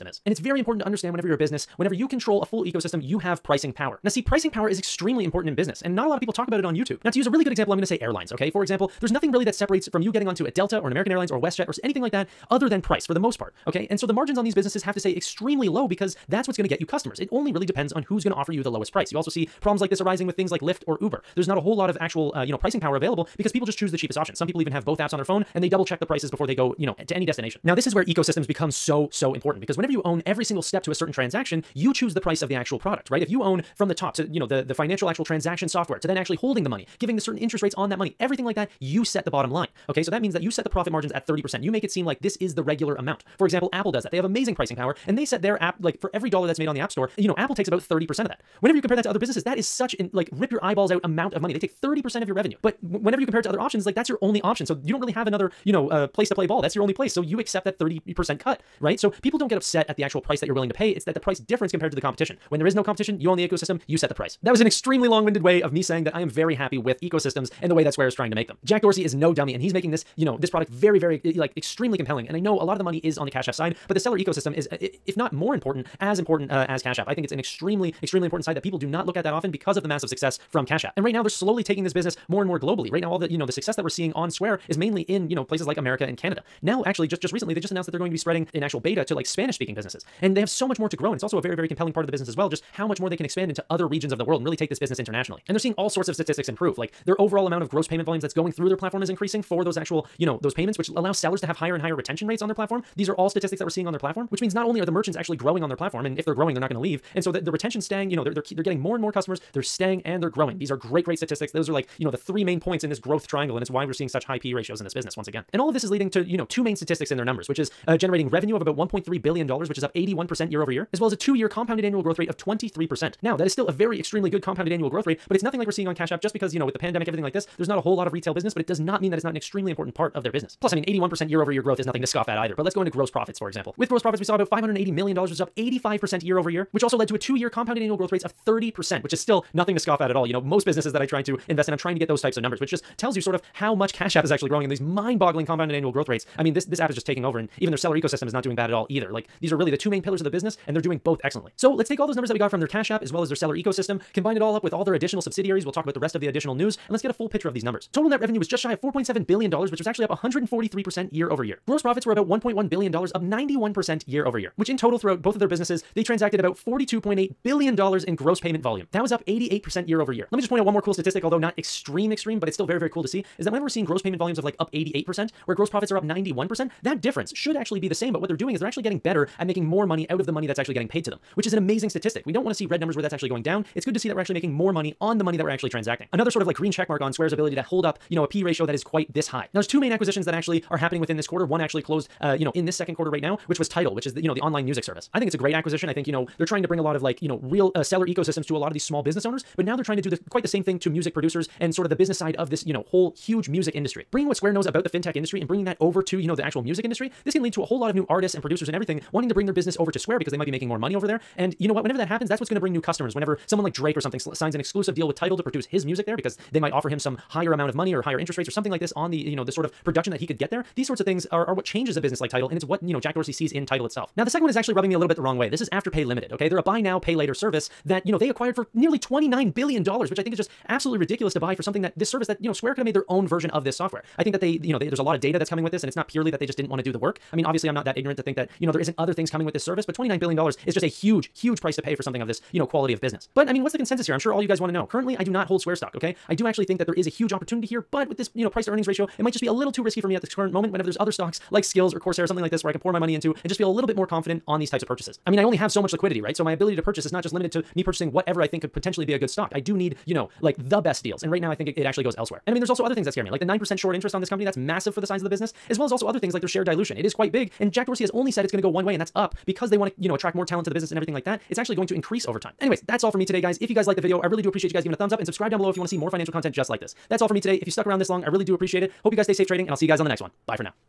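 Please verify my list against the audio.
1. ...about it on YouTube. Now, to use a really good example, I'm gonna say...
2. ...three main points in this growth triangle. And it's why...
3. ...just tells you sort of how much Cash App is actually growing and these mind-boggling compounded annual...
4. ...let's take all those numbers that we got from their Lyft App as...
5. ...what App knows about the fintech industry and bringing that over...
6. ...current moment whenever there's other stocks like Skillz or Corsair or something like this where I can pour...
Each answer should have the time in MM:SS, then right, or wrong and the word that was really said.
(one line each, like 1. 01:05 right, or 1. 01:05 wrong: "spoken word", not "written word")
1. 00:06 right
2. 01:52 right
3. 02:22 right
4. 02:31 wrong: "Cash", not "Lyft"
5. 03:24 wrong: "Square", not "App"
6. 04:10 right.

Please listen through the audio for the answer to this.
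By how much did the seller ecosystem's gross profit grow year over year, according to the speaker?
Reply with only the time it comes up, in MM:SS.
02:15.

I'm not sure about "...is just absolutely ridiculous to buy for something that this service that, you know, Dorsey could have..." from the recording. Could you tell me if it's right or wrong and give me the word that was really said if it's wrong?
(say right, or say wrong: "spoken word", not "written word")
wrong: "Square", not "Dorsey".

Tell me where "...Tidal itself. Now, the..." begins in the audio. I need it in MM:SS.
03:43.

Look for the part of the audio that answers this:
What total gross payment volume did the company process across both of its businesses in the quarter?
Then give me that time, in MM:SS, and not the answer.
02:46.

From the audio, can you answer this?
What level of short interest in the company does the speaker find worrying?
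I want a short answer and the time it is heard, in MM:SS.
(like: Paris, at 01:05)
9%, at 04:23.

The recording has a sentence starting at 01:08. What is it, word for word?
Jack Dorsey is no dummy and he's making this, you know, this product very, very, like extremely compelling.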